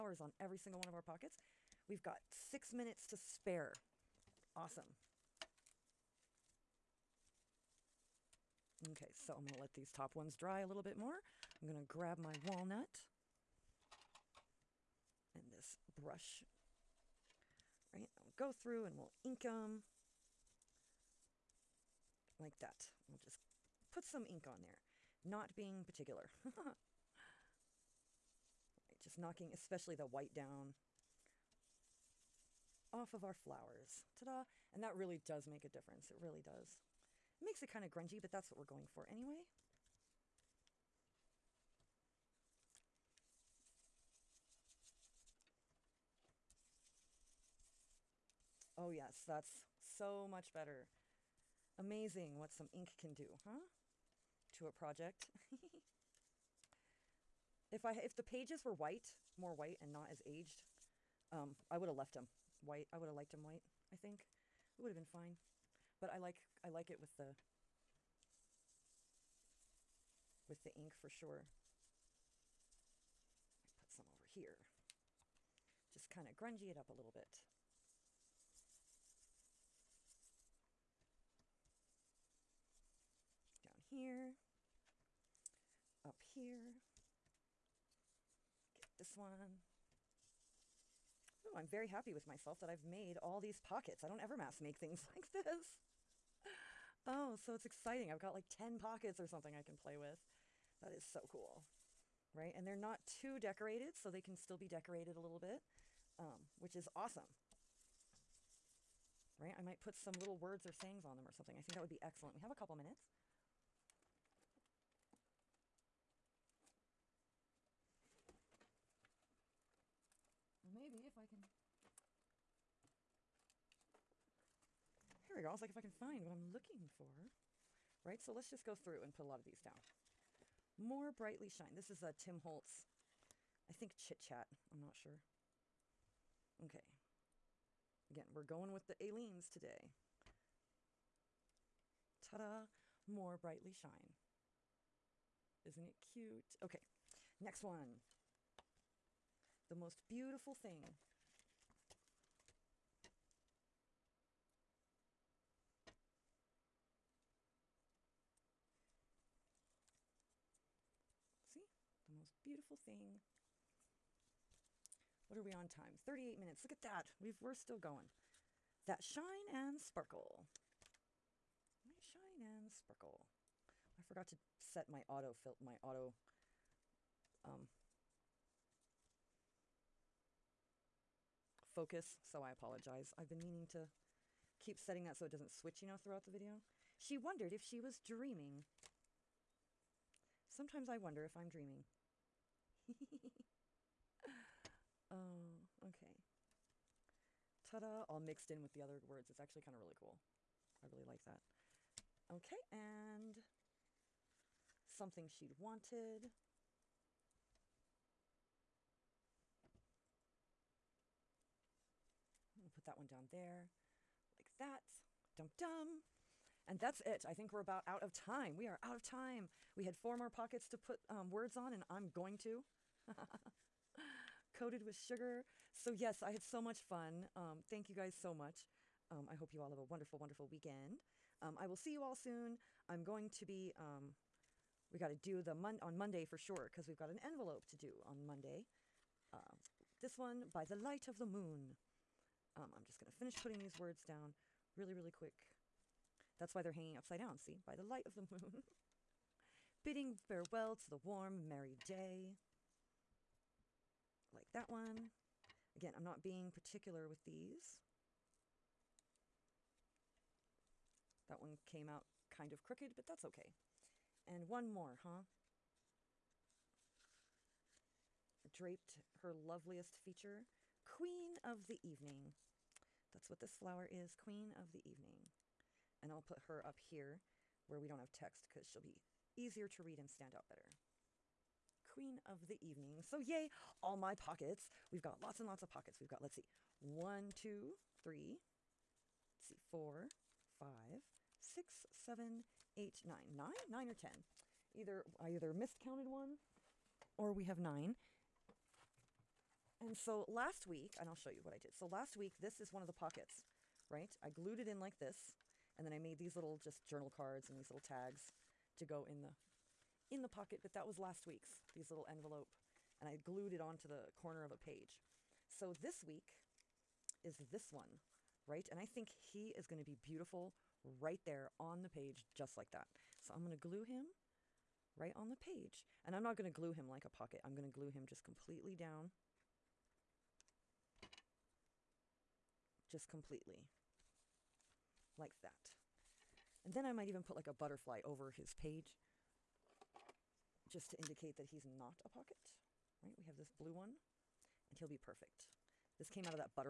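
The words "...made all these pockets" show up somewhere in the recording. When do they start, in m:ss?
1:32.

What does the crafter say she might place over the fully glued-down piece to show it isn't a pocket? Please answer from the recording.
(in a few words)
A butterfly.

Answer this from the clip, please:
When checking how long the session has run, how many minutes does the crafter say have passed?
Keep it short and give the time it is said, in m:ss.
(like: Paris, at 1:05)
38 minutes, at 2:45.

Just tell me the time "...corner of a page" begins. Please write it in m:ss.
5:14.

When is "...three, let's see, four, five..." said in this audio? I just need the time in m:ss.
4:47.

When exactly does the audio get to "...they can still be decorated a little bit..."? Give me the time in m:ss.
1:44.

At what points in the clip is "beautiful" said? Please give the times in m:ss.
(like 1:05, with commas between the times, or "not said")
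2:30, 2:42, 5:19.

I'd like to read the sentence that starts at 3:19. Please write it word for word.
It's actually kind of really cool.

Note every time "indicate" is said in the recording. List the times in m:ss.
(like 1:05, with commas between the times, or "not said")
5:40.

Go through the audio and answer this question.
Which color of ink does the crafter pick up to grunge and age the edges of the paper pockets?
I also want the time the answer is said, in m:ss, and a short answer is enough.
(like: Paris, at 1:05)
Walnut, at 0:12.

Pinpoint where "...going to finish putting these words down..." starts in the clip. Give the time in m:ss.
4:02.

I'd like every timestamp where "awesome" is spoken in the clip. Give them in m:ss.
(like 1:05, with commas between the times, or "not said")
0:04, 1:46.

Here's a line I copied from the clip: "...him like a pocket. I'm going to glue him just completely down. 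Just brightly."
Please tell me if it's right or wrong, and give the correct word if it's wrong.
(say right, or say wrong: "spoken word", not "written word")
wrong: "completely", not "brightly".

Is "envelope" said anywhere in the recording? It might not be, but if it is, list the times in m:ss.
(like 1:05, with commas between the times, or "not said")
3:57, 5:12.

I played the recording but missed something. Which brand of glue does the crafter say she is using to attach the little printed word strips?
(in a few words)
Aleene's.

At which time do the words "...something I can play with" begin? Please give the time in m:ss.
1:39.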